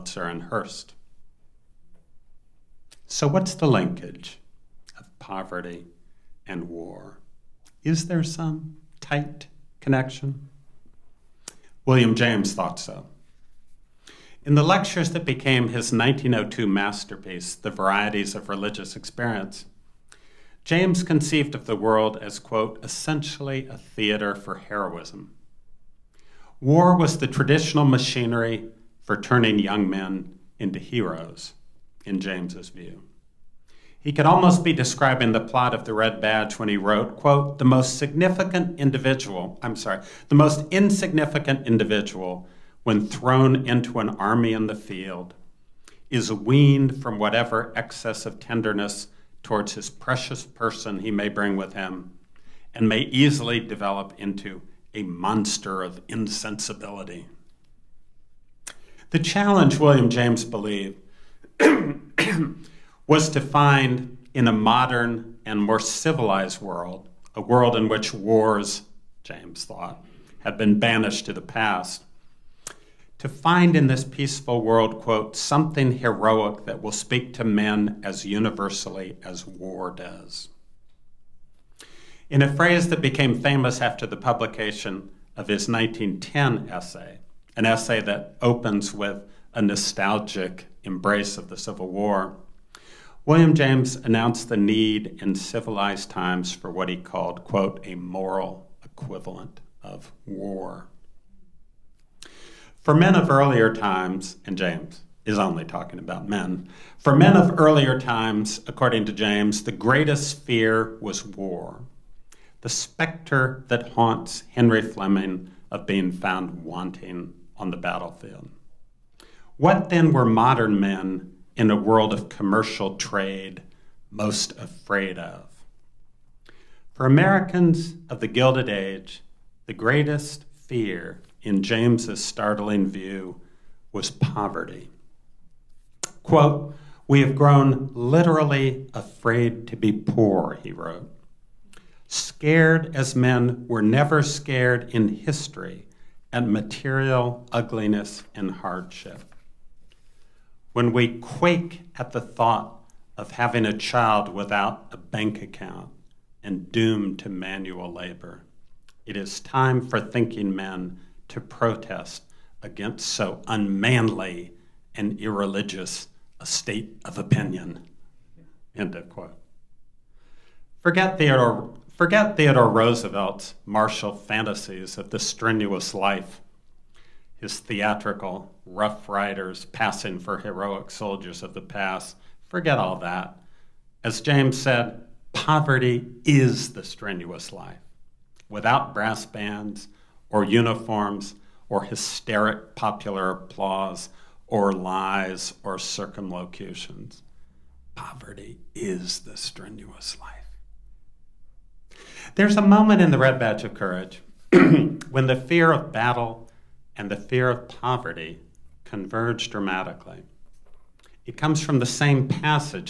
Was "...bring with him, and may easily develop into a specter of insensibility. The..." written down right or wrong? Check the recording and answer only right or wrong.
wrong.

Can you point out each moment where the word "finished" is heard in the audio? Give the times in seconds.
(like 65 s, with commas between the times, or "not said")
not said.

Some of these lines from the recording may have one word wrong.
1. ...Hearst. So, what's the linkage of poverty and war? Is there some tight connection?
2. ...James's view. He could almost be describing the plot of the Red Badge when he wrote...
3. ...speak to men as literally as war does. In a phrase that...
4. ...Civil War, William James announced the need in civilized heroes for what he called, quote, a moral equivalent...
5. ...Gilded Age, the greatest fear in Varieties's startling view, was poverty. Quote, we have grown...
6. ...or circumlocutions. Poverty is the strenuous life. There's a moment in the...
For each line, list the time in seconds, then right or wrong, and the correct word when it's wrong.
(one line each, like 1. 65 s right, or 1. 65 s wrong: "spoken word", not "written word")
1. 0 s right
2. 32 s right
3. 76 s wrong: "universally", not "literally"
4. 91 s wrong: "times", not "heroes"
5. 128 s wrong: "James", not "Varieties"
6. 195 s right.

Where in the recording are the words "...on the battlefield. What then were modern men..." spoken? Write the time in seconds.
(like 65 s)
117 s.